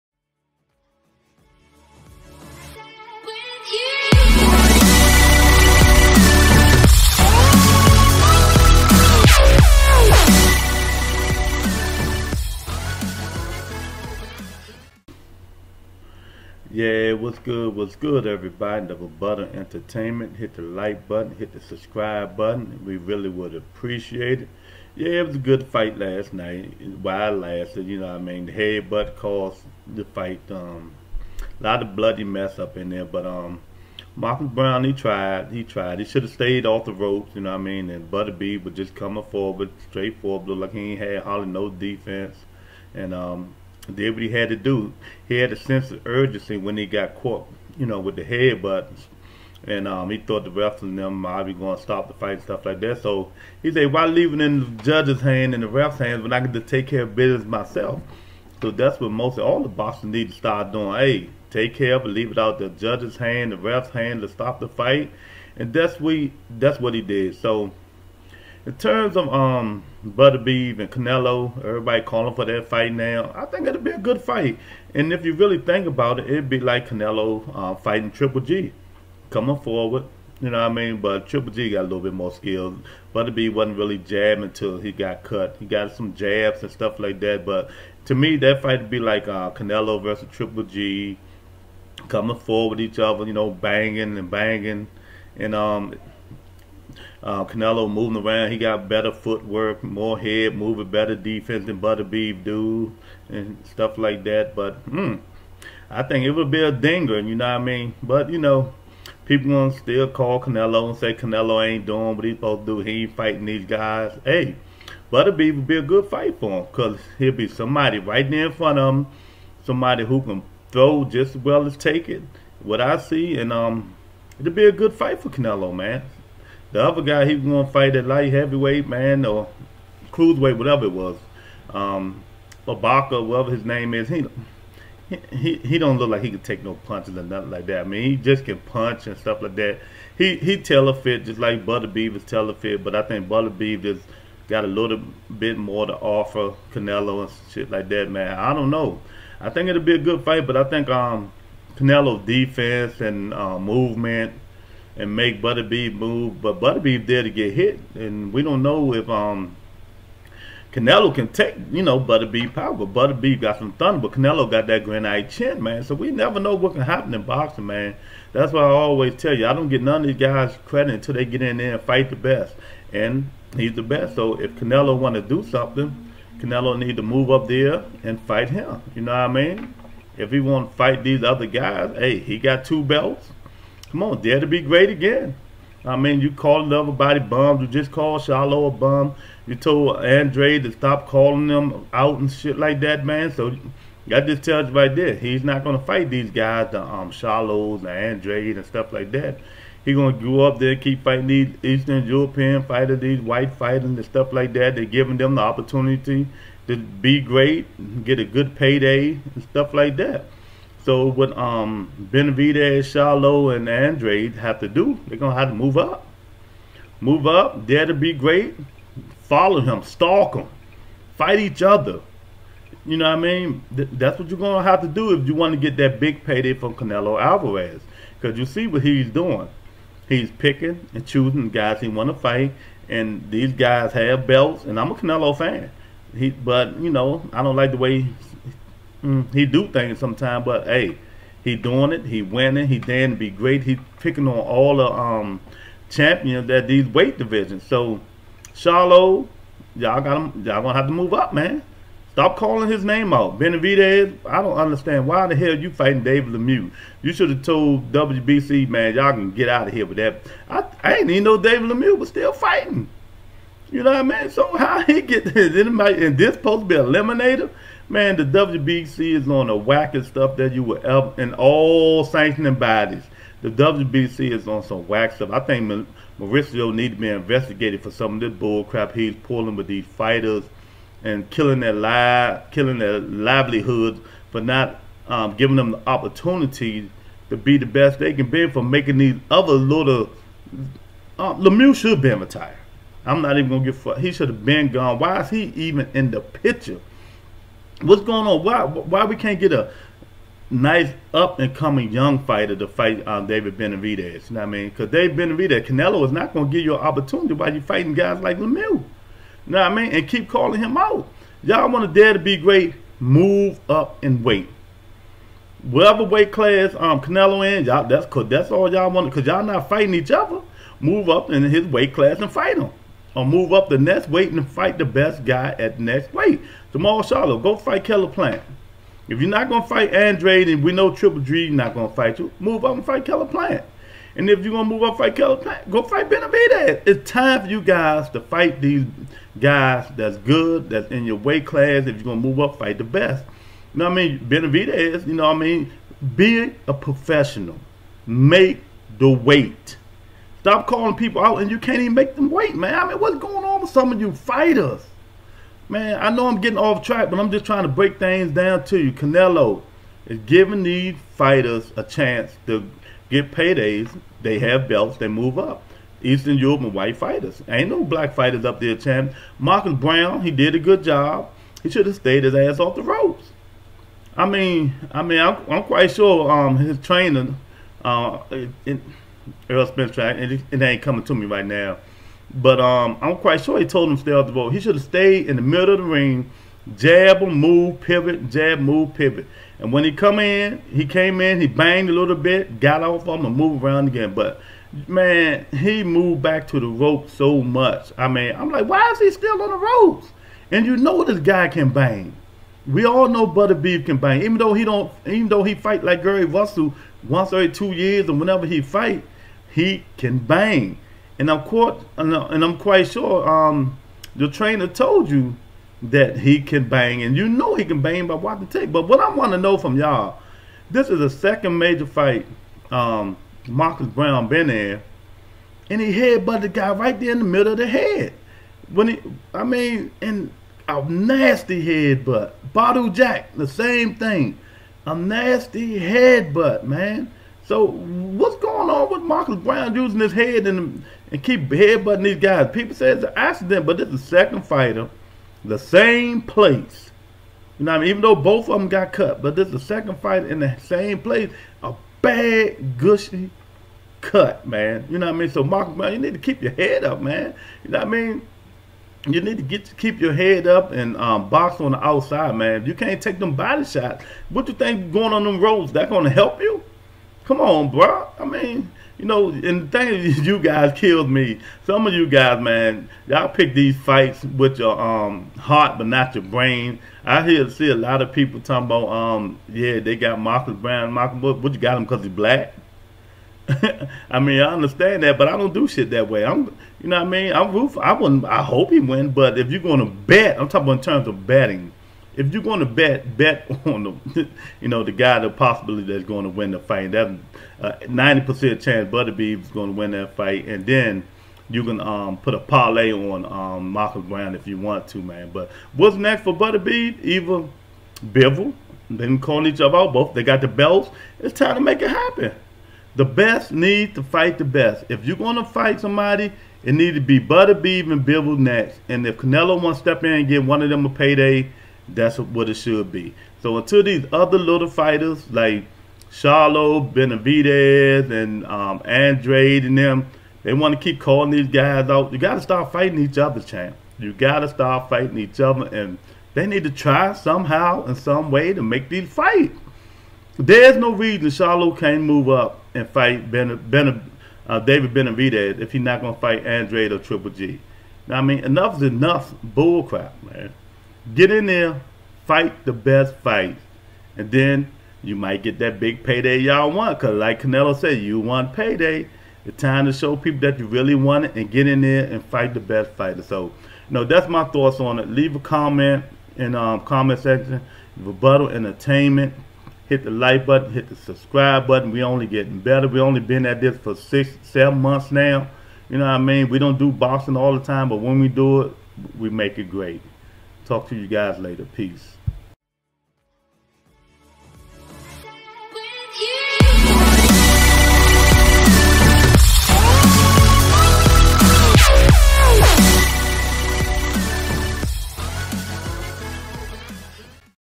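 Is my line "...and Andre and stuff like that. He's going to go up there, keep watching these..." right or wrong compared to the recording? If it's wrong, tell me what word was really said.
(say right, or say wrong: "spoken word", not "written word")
wrong: "fighting", not "watching".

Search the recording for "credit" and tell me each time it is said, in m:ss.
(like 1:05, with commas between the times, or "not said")
2:50.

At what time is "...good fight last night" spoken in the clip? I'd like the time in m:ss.
0:25.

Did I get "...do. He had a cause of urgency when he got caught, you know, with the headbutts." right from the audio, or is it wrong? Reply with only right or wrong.
wrong.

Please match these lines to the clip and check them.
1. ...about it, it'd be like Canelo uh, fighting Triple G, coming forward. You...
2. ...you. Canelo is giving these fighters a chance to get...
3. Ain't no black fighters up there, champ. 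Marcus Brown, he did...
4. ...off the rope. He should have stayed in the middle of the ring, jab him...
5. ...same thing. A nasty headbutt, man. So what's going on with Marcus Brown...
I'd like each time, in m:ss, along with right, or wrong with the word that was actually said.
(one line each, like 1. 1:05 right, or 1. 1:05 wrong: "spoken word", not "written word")
1. 1:15 right
2. 5:58 right
3. 6:07 right
4. 6:24 right
5. 7:13 right.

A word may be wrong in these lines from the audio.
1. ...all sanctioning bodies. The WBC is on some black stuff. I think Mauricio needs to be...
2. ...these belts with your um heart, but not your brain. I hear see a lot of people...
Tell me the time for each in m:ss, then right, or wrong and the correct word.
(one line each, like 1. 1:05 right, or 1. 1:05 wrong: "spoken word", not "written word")
1. 4:31 wrong: "whack", not "black"
2. 7:53 wrong: "fights", not "belts".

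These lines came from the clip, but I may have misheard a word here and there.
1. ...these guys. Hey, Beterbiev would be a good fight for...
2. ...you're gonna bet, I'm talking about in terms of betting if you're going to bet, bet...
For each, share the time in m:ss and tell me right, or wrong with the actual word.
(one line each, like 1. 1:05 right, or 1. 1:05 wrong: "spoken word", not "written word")
1. 1:53 right
2. 8:09 right.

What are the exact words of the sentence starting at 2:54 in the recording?
So if Canelo want to do something.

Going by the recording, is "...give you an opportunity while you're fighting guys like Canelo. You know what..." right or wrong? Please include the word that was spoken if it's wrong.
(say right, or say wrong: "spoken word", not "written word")
wrong: "Lemieux", not "Canelo".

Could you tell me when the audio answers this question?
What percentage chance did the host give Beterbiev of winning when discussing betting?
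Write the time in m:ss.
8:17.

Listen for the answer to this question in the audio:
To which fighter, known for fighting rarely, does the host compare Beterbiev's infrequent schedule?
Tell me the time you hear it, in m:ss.
6:46.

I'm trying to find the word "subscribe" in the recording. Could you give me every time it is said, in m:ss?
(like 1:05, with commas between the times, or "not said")
0:21, 9:30.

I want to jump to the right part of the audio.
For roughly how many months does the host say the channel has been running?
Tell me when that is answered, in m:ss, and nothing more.
9:33.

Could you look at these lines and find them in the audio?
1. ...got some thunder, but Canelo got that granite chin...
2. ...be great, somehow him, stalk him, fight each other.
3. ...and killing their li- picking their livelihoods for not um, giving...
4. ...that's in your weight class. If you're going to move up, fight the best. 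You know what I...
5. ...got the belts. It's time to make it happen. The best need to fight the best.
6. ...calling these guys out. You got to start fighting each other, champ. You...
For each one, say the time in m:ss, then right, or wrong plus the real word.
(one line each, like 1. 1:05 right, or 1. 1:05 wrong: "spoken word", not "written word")
1. 2:43 right
2. 3:37 wrong: "follow", not "somehow"
3. 4:41 wrong: "killing", not "picking"
4. 5:40 right
5. 8:30 right
6. 8:50 right.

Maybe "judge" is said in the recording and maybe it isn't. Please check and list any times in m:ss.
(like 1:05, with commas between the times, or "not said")
0:54, 1:02.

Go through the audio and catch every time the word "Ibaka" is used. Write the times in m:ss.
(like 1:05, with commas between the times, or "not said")
2:12.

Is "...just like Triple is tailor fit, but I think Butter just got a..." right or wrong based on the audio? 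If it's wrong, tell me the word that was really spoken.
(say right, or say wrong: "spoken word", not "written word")
wrong: "Beterbiev", not "Triple".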